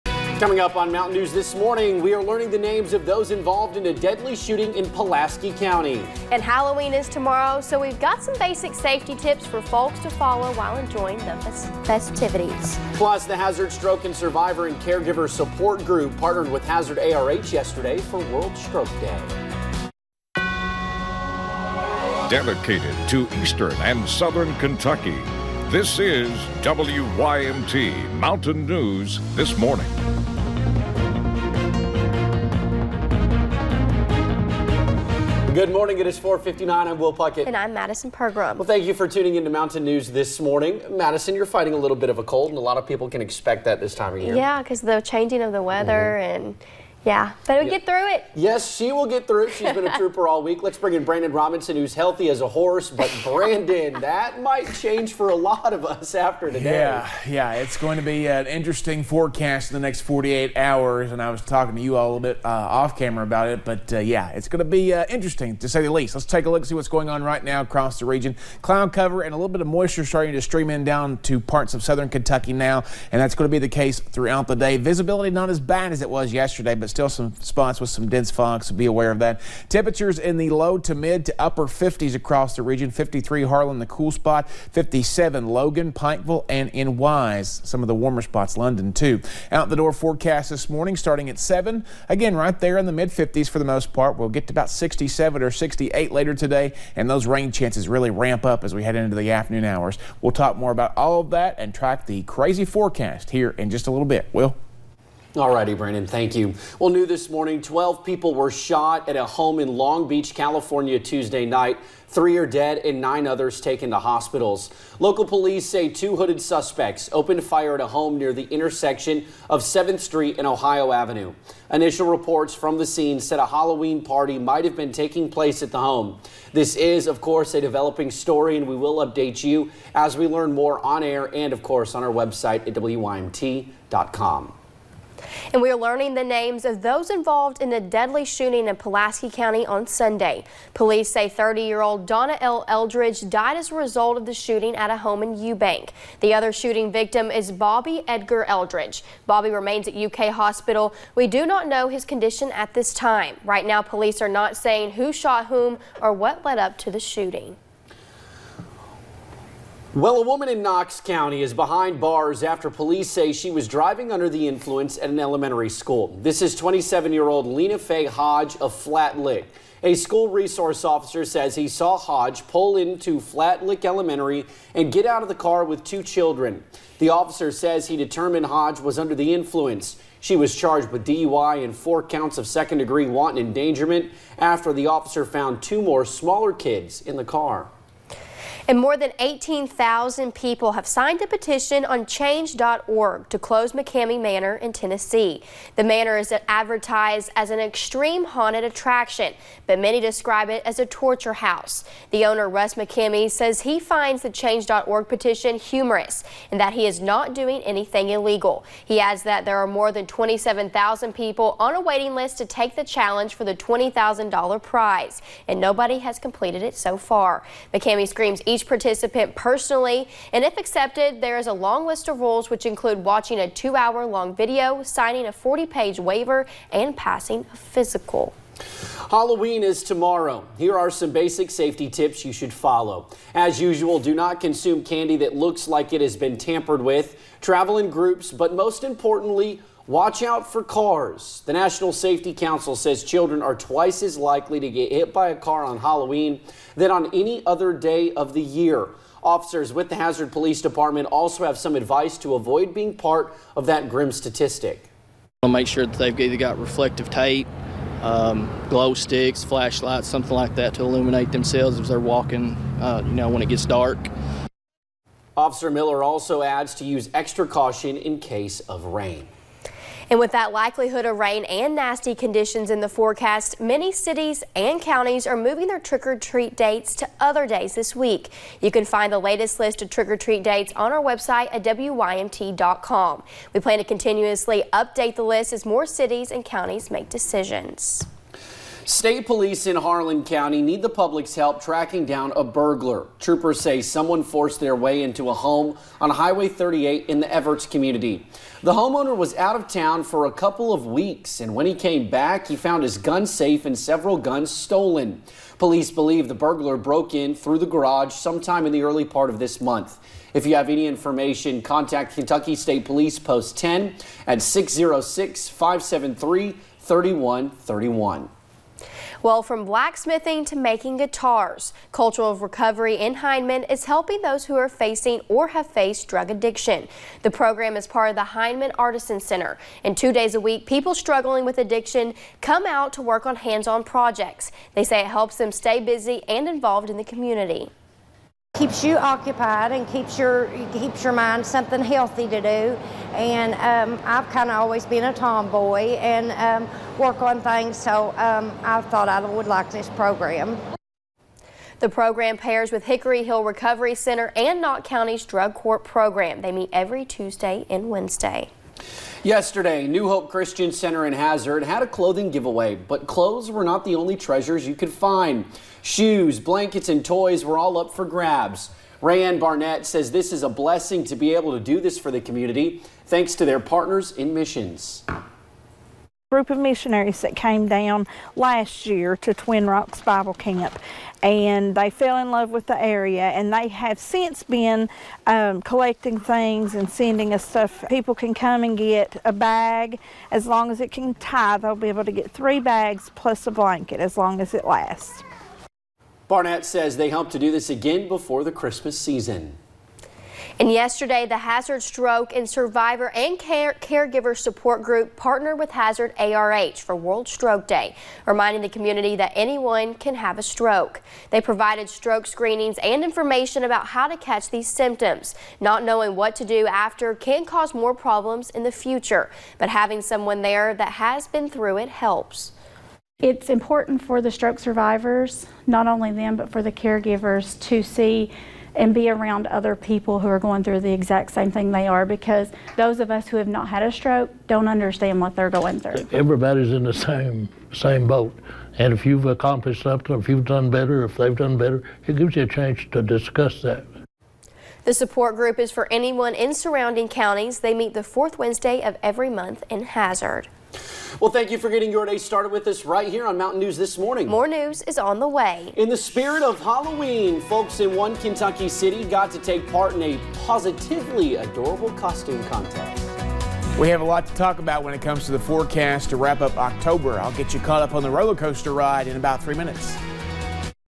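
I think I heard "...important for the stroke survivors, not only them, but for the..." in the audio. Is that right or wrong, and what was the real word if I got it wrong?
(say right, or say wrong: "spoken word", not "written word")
right.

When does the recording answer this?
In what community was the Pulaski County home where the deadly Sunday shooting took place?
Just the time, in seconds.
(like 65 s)
145 s.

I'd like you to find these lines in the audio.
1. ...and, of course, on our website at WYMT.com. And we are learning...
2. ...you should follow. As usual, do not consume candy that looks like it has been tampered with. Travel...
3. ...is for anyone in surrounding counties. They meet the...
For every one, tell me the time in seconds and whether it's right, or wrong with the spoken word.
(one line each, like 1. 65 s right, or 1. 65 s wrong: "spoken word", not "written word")
1. 131 s right
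2. 232 s right
3. 445 s right.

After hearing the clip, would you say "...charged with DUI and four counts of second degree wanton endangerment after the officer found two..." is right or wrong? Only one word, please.
right.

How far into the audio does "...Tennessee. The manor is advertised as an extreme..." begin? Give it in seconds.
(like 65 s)
194 s.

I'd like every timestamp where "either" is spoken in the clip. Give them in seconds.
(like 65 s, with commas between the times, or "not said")
256 s.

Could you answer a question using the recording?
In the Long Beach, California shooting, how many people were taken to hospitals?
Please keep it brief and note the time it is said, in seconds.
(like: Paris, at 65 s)
9, at 112 s.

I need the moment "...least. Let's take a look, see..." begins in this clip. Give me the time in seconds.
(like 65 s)
65 s.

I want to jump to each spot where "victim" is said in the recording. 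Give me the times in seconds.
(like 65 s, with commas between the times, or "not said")
146 s.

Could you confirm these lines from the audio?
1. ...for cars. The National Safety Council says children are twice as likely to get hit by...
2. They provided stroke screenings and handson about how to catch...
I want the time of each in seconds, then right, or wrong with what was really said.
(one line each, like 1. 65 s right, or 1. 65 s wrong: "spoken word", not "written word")
1. 240 s right
2. 411 s wrong: "information", not "handson".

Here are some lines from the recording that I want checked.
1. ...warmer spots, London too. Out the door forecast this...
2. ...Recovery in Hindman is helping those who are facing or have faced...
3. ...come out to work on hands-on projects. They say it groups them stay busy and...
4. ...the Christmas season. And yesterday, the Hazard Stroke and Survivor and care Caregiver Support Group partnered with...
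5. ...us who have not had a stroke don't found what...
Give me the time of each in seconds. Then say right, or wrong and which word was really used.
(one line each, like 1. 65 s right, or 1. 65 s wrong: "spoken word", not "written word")
1. 87 s right
2. 322 s right
3. 332 s wrong: "helps", not "groups"
4. 398 s right
5. 433 s wrong: "understand", not "found".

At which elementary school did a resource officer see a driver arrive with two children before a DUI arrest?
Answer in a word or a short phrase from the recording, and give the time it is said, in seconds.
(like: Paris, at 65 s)
Flat Lick Elementary, at 173 s.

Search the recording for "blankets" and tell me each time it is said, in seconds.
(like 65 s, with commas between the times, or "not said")
366 s, 393 s.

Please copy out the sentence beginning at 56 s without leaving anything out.
Yeah, yeah, it's going to be an interesting forecast in the next 48 hours.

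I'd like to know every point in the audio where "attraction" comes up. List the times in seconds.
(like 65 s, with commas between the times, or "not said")
198 s.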